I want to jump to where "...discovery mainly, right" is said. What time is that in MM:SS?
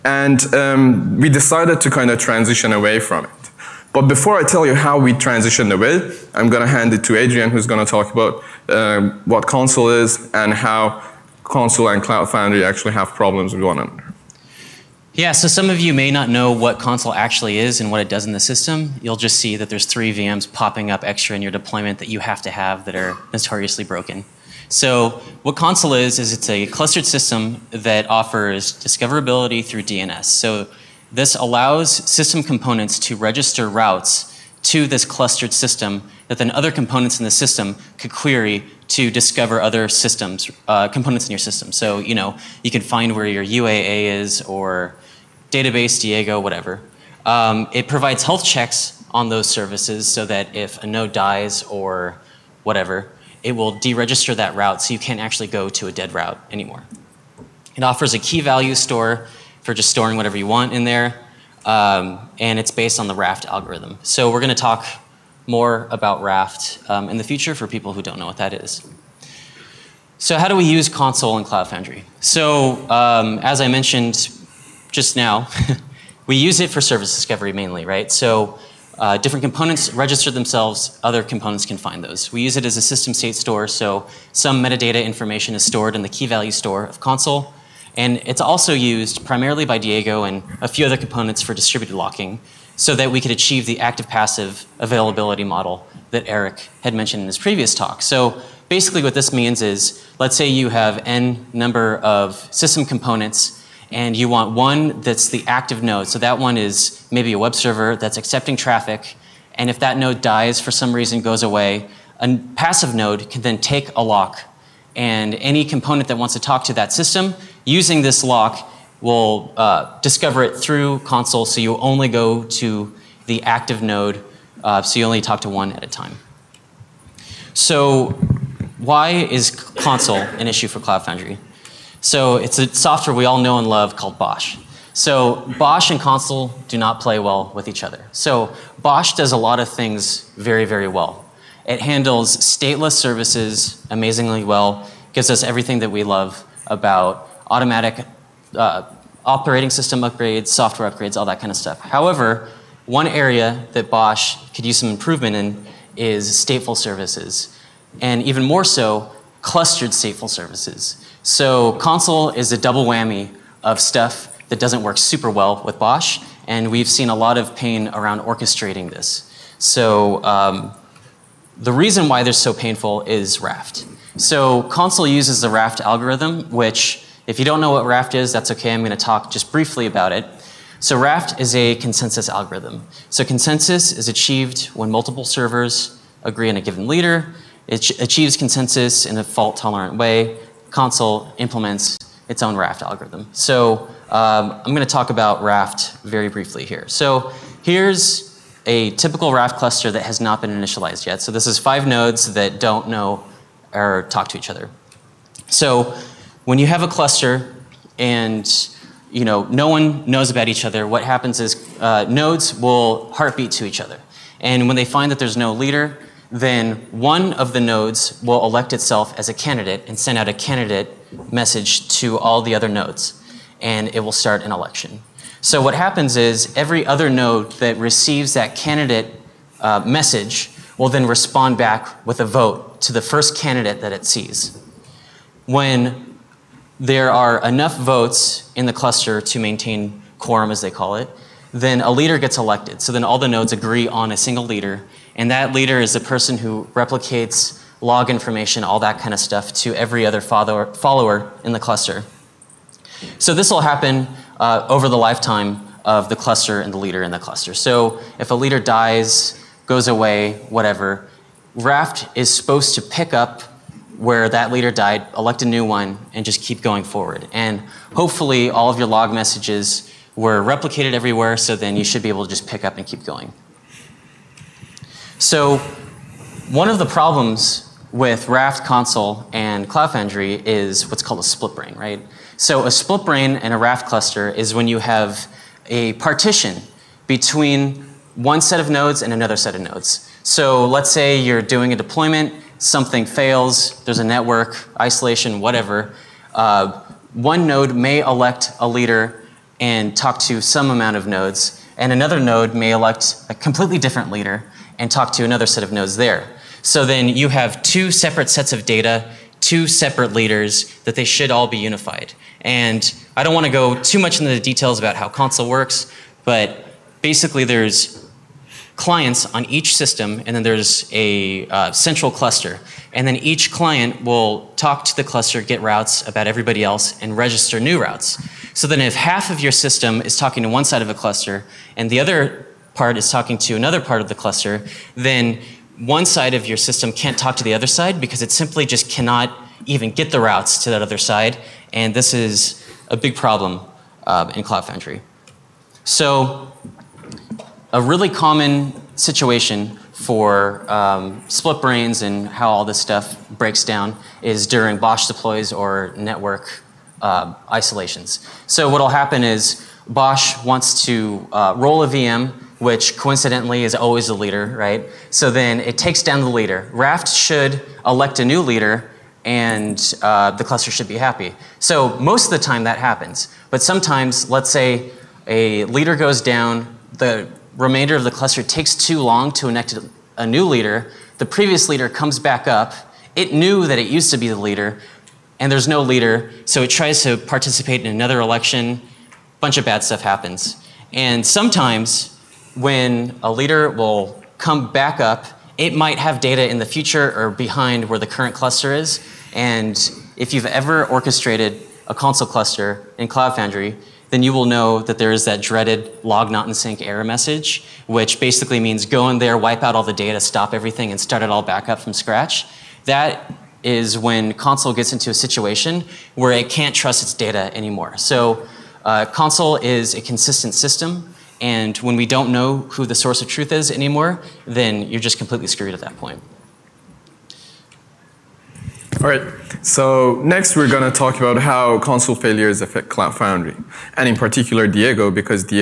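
01:17.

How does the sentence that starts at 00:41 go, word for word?
So, you know, you can find where your UAA is or database, Diego, whatever.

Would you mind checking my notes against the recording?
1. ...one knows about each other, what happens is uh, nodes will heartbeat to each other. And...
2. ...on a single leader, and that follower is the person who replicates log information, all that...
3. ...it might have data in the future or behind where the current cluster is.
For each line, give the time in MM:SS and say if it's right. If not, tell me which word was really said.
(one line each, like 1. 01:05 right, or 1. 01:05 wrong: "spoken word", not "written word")
1. 03:29 right
2. 04:03 wrong: "leader", not "follower"
3. 06:35 right.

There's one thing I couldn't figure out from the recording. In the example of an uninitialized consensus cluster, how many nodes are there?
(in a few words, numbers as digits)
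5.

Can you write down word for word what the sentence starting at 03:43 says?
And it will start an election.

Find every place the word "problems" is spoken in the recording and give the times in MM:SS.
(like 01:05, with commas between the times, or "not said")
00:13, 04:36, 05:43.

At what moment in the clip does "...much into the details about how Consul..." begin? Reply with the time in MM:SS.
05:13.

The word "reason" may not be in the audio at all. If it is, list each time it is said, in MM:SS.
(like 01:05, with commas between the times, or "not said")
01:50, 02:51.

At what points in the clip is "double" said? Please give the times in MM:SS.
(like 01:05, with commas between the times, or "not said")
02:42.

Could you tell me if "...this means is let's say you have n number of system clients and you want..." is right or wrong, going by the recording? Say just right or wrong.
wrong.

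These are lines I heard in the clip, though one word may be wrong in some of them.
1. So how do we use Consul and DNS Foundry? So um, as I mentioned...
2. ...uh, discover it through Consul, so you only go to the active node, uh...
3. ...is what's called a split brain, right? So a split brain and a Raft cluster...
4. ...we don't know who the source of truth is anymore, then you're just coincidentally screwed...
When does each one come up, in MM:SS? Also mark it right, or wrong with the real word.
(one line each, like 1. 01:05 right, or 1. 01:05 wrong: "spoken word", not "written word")
1. 01:10 wrong: "Cloud", not "DNS"
2. 01:59 right
3. 04:40 right
4. 07:01 wrong: "completely", not "coincidentally".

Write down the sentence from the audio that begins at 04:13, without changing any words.
So this will happen uh, over the lifetime of the cluster and the leader in the cluster.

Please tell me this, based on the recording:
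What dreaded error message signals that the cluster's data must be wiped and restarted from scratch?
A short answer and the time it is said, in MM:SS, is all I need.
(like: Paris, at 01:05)
log not in sync, at 06:46.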